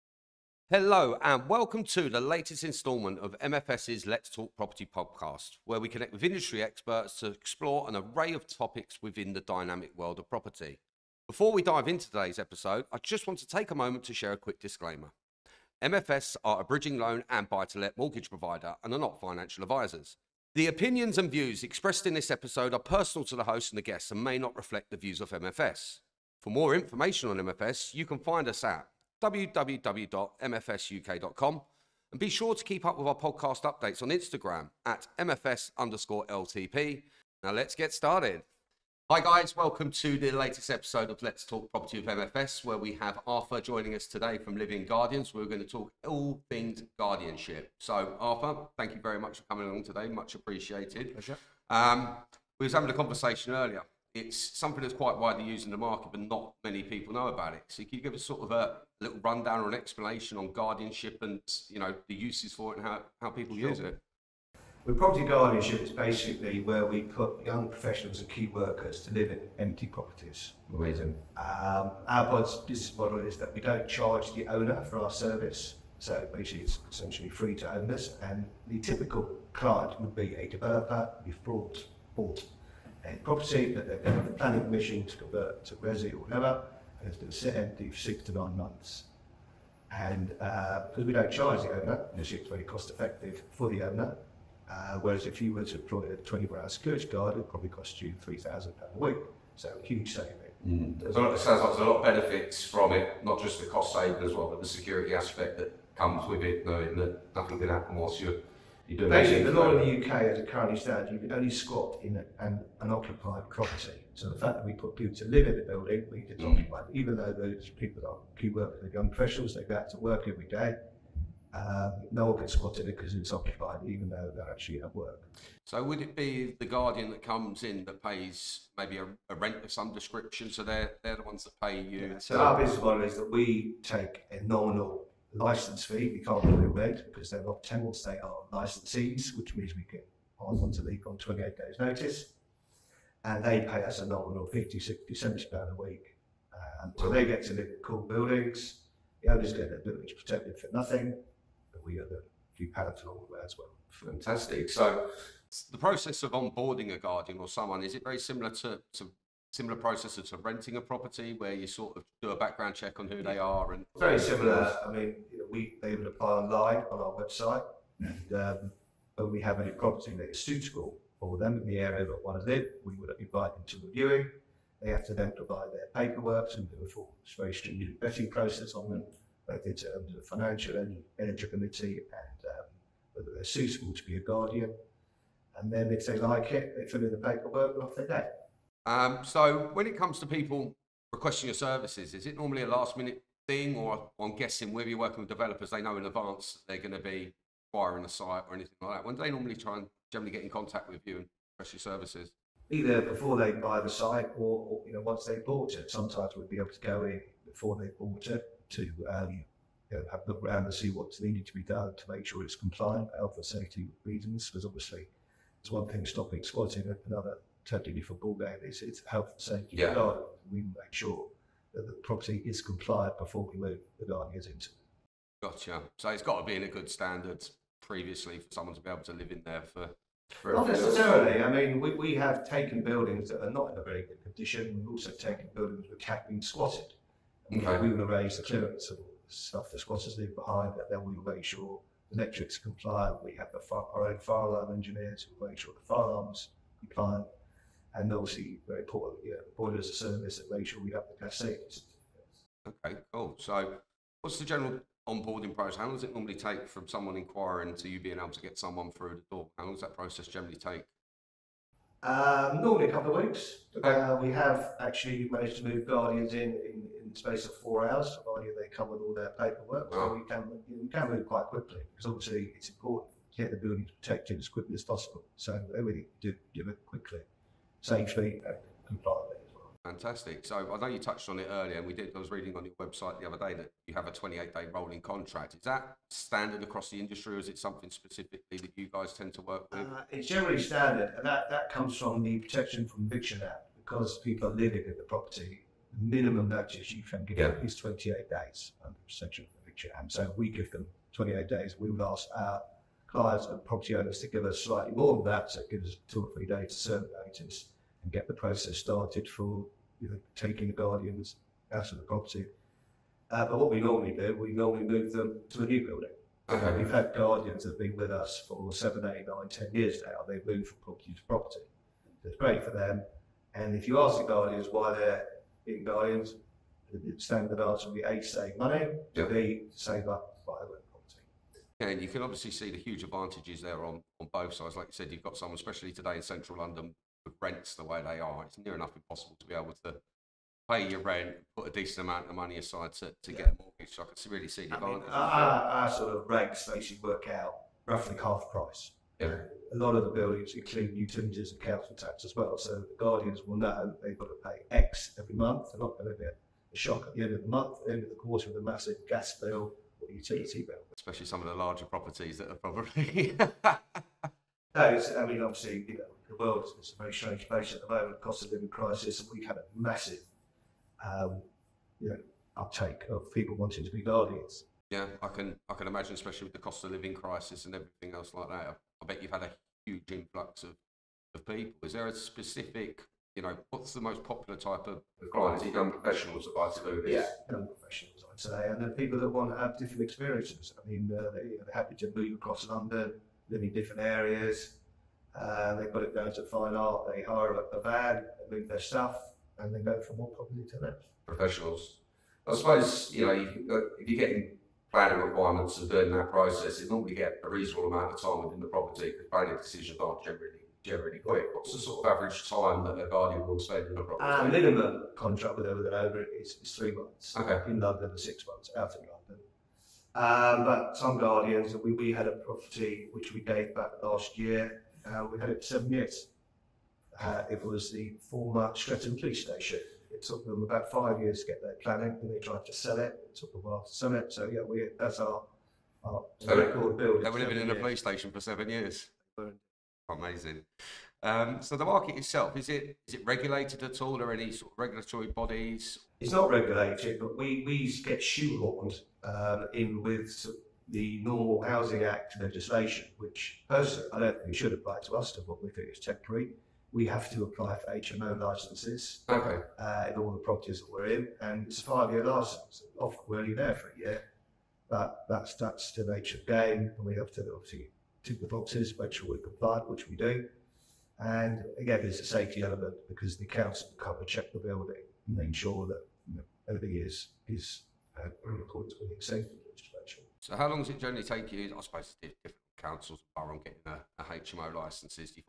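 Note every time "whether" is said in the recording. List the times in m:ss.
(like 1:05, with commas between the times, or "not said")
3:03, 3:14.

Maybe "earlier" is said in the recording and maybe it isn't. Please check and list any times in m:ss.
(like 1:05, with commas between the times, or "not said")
0:53, 4:41.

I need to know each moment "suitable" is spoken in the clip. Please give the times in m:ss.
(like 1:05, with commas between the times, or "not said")
2:50, 3:03.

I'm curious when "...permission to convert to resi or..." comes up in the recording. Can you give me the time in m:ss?
1:24.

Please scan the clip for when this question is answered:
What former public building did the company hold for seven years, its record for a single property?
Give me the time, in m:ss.
7:08.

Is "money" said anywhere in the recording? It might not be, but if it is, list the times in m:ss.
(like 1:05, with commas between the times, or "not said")
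5:28, 5:42.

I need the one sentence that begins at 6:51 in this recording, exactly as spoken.
What's the sort of average time that a guardian will spend in a property?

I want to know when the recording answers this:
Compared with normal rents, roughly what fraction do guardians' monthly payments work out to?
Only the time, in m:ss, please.
5:47.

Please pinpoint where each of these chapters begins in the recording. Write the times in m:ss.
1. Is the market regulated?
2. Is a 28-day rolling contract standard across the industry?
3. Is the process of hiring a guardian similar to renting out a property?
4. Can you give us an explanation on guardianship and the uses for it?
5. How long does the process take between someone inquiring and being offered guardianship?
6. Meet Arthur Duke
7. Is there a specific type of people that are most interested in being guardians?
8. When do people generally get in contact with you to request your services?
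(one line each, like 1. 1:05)
1. 7:21
2. 4:43
3. 2:35
4. 0:51
5. 4:14
6. 0:29
7. 6:20
8. 3:08.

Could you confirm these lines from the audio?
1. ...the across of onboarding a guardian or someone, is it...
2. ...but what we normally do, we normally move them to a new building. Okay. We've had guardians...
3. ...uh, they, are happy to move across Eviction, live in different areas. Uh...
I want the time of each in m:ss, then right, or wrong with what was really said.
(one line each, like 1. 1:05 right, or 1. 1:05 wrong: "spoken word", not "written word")
1. 2:35 wrong: "process", not "across"
2. 5:13 right
3. 6:31 wrong: "London", not "Eviction".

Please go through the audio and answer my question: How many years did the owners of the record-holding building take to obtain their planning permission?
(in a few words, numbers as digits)
5 years.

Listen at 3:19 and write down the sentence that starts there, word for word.
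When do they normally try and generally get in contact with you and request your services?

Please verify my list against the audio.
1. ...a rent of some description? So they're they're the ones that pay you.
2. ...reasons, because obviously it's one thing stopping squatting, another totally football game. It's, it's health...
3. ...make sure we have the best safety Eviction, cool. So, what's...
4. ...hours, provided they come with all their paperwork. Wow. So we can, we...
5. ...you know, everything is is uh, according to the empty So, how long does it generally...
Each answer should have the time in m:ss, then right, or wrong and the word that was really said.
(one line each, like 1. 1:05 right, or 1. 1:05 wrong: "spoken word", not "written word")
1. 2:09 right
2. 3:34 right
3. 4:10 wrong: "Okay", not "Eviction"
4. 4:27 right
5. 7:56 wrong: "safety", not "empty".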